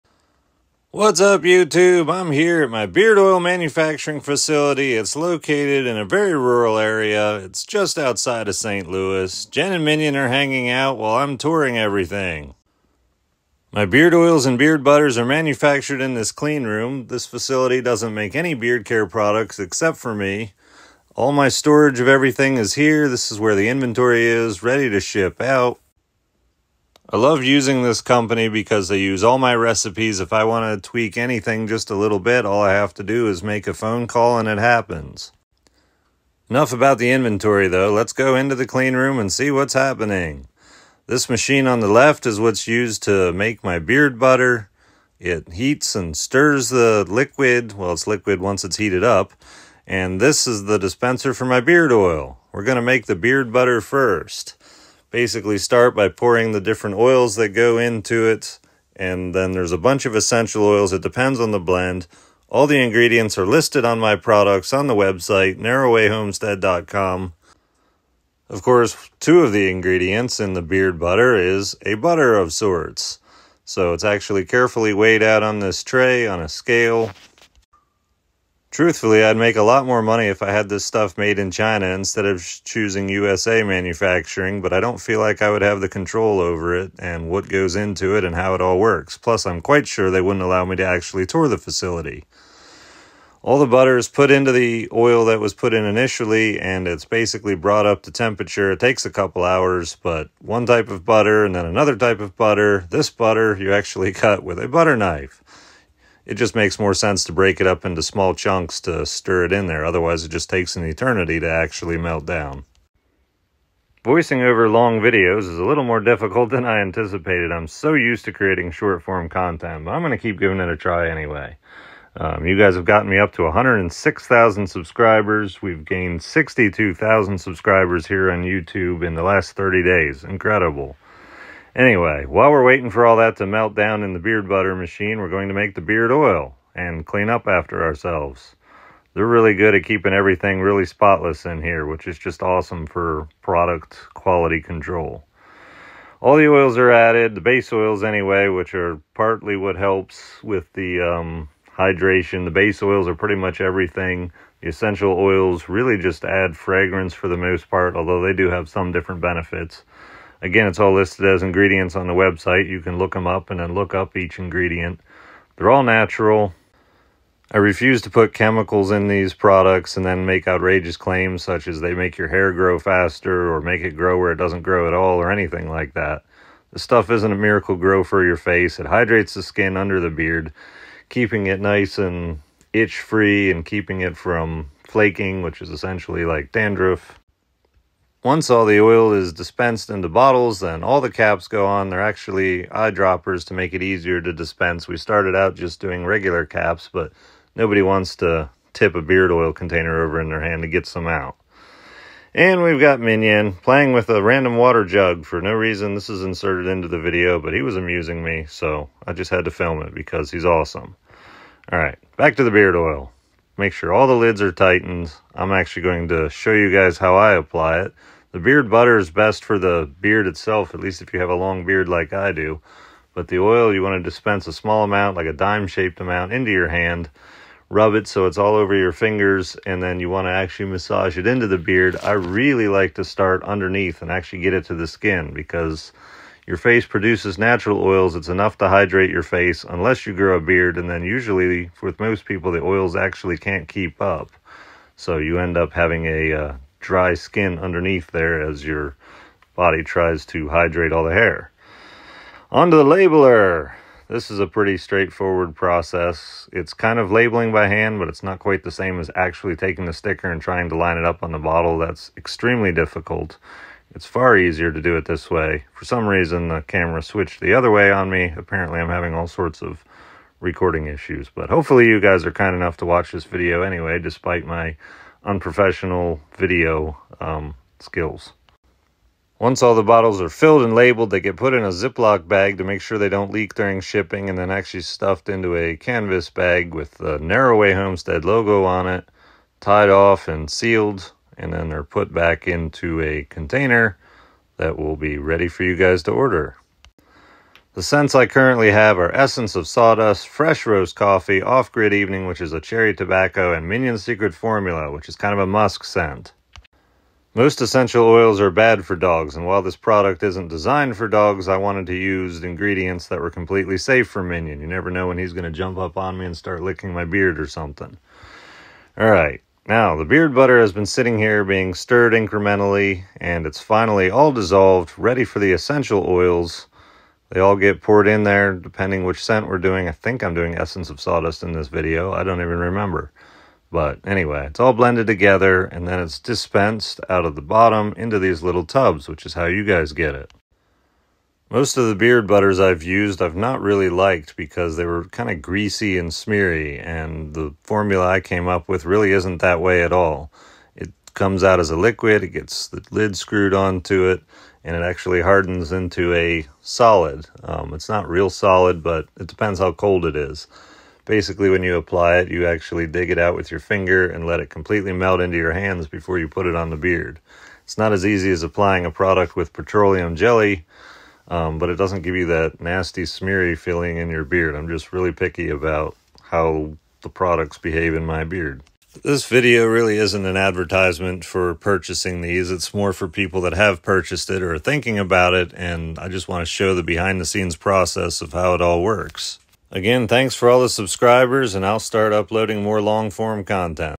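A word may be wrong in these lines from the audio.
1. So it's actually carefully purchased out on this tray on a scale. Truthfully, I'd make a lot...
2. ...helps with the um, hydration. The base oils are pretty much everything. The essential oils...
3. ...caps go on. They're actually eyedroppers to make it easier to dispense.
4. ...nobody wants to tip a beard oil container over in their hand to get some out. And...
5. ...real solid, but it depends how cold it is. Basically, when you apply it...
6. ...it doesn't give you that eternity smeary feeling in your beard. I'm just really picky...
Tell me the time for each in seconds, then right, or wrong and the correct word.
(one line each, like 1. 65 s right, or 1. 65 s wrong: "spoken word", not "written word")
1. 73 s wrong: "weighed", not "purchased"
2. 149 s right
3. 191 s right
4. 197 s right
5. 358 s right
6. 371 s wrong: "nasty", not "eternity".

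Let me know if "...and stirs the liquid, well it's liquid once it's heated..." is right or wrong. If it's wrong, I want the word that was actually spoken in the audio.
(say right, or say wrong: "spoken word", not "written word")
right.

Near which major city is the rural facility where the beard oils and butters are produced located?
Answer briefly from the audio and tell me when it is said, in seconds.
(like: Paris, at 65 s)
St. Louis, at 8 s.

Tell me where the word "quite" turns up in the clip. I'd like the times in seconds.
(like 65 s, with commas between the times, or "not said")
89 s, 258 s.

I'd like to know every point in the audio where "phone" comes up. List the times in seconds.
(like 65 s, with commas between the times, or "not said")
33 s.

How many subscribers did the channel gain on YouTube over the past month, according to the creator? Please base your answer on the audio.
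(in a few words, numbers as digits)
62,000.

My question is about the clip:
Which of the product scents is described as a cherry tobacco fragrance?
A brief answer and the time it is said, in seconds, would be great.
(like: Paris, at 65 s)
Off Grid Evening, at 301 s.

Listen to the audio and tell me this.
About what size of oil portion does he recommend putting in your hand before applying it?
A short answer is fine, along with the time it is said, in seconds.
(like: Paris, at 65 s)
Dime-shaped, at 225 s.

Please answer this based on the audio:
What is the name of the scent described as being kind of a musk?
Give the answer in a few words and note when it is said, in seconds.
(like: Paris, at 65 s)
Minion Secret Formula, at 303 s.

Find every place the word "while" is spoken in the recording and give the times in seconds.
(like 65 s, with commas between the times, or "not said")
10 s, 132 s, 309 s.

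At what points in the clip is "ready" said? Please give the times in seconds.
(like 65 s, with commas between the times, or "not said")
24 s, 295 s, 324 s.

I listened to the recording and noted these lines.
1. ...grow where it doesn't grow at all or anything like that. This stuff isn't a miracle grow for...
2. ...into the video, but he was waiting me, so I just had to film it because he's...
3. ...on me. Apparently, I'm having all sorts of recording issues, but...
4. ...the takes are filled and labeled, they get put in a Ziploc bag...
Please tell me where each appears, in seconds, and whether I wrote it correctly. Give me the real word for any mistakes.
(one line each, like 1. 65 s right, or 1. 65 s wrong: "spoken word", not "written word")
1. 173 s right
2. 206 s wrong: "amusing", not "waiting"
3. 267 s right
4. 279 s wrong: "bottles", not "takes".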